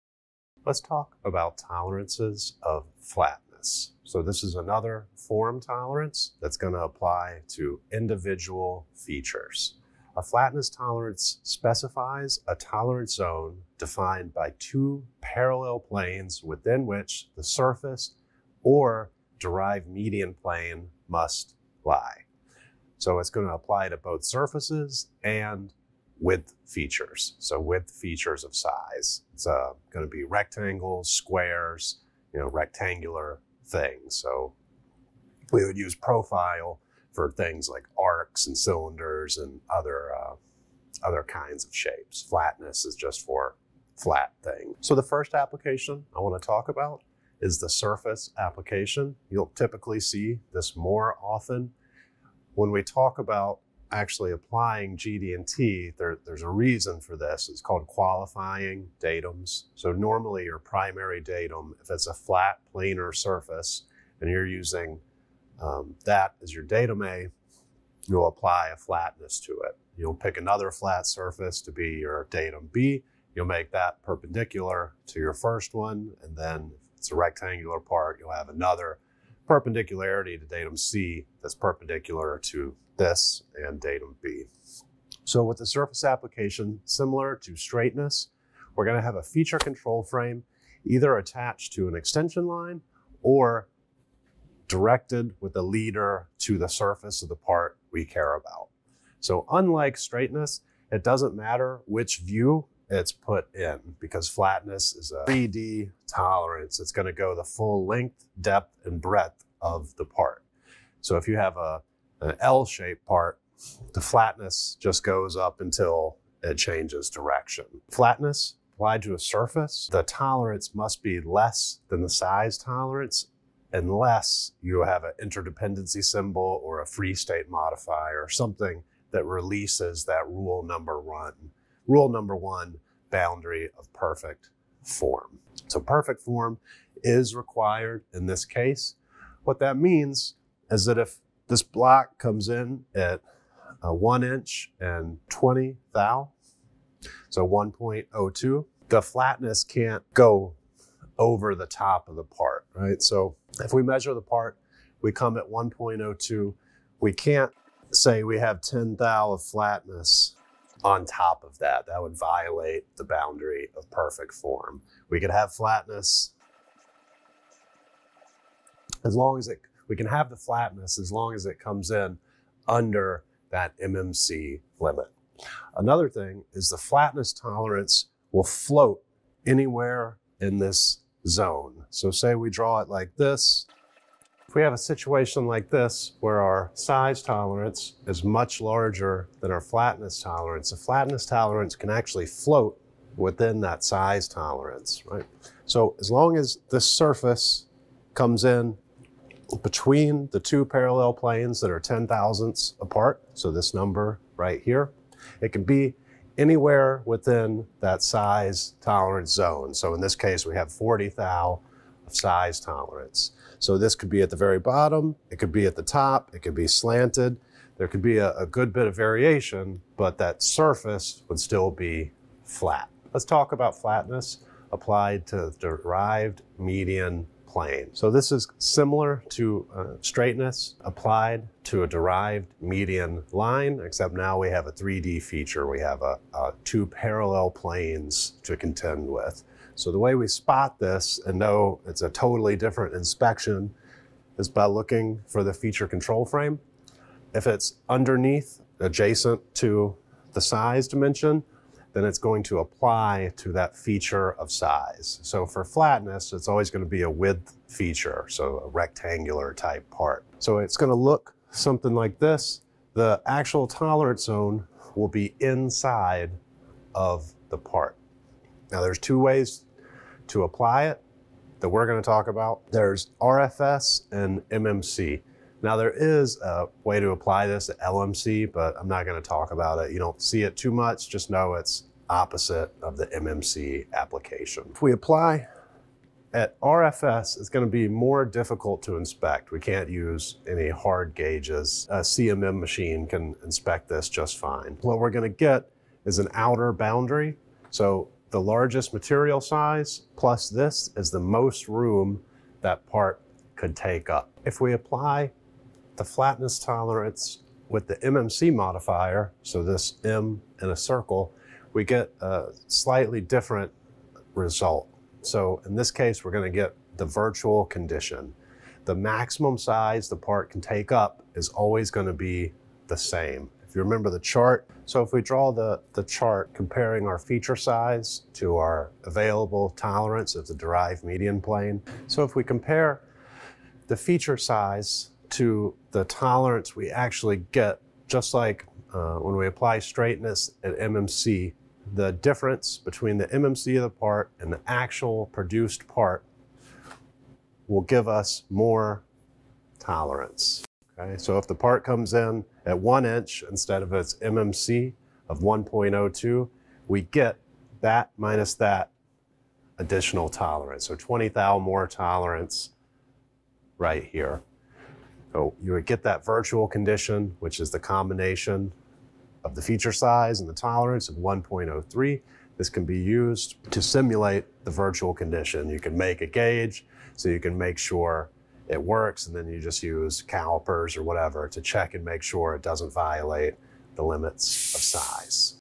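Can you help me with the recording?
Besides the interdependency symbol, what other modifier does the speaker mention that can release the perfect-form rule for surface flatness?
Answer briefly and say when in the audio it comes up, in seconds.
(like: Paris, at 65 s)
Free state modifier, at 126 s.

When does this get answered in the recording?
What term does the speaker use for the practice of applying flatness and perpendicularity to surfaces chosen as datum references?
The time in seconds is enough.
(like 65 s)
57 s.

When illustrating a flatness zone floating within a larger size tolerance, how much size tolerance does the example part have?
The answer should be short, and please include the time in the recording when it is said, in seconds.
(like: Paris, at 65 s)
40 thou, at 210 s.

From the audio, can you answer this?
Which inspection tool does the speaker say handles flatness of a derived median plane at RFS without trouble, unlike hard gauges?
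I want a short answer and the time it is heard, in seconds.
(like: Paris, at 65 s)
CMM machine, at 292 s.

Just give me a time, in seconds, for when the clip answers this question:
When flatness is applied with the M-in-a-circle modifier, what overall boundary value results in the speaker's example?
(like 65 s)
371 s.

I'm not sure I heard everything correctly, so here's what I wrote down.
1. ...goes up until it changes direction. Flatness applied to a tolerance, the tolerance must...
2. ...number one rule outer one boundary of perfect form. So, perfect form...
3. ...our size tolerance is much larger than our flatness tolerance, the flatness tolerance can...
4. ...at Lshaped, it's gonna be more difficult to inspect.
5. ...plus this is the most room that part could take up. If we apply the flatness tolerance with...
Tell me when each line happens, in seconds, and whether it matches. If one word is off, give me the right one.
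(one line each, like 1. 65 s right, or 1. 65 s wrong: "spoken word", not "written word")
1. 115 s wrong: "surface", not "tolerance"
2. 130 s wrong: "number", not "outer"
3. 186 s right
4. 286 s wrong: "RFS", not "Lshaped"
5. 300 s right.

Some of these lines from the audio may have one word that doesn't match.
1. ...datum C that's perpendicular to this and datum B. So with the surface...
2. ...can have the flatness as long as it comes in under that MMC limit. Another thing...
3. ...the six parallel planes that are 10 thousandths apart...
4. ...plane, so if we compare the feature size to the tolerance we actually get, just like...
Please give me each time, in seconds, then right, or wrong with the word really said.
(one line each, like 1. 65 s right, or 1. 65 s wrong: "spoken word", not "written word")
1. 80 s right
2. 169 s right
3. 200 s wrong: "two", not "six"
4. 331 s right.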